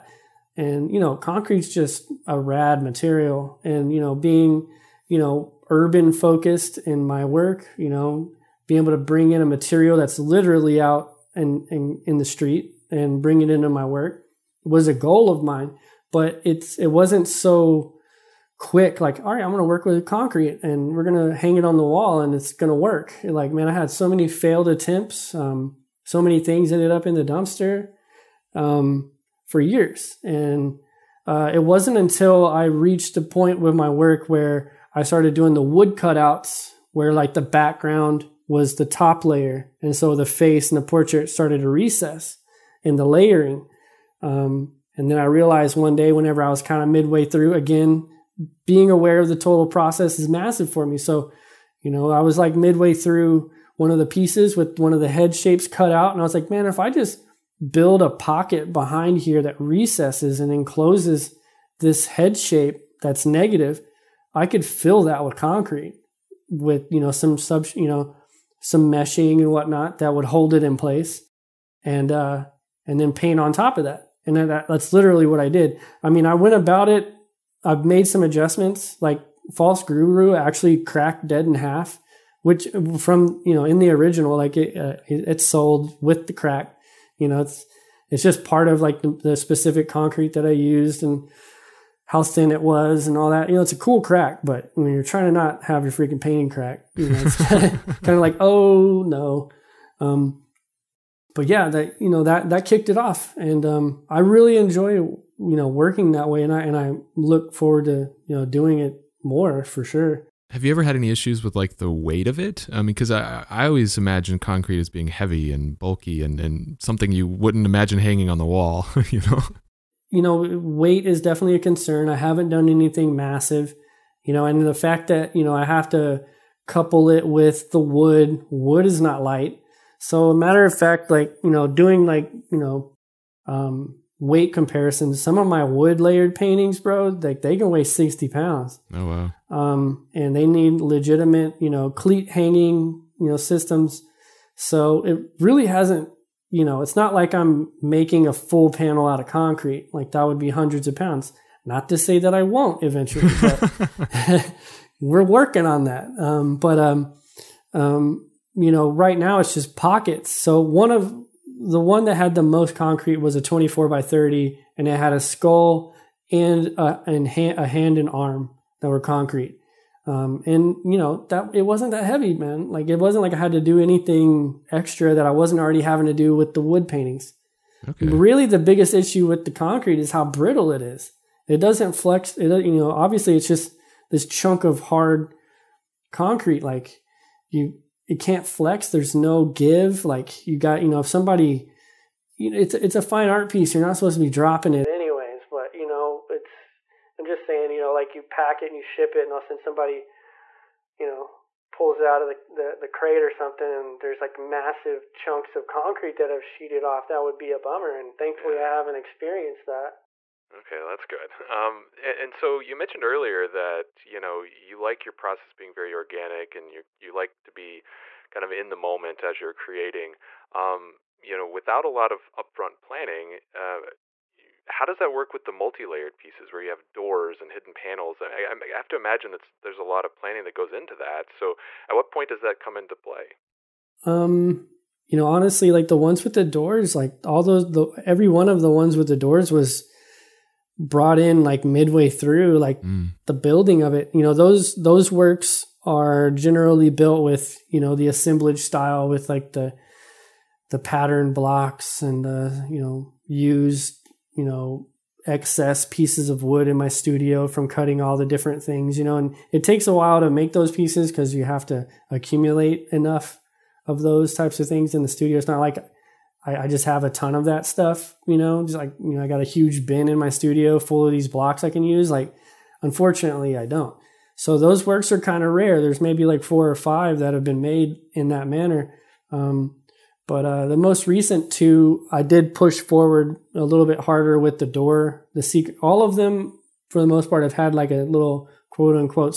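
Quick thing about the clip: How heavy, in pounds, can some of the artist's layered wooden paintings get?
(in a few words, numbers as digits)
60.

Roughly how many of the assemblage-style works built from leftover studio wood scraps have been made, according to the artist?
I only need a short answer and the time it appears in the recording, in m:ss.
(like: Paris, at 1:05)
4 or 5, at 4:36.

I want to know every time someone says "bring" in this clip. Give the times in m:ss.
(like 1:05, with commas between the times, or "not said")
0:08, 0:13.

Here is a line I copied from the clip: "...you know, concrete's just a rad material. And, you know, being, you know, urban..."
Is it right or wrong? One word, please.
right.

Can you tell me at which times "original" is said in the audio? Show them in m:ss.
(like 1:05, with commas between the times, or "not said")
1:23.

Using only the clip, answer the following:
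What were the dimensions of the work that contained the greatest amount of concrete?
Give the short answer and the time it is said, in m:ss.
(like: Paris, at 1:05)
24 by 30, at 2:43.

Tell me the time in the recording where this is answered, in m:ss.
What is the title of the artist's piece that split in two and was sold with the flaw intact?
1:19.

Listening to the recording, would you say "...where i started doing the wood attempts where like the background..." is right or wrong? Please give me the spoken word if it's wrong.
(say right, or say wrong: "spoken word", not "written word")
wrong: "cutouts", not "attempts".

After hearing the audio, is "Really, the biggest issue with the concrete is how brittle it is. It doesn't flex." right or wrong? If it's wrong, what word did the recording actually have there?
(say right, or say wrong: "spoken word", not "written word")
right.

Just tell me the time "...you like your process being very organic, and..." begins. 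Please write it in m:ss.
3:34.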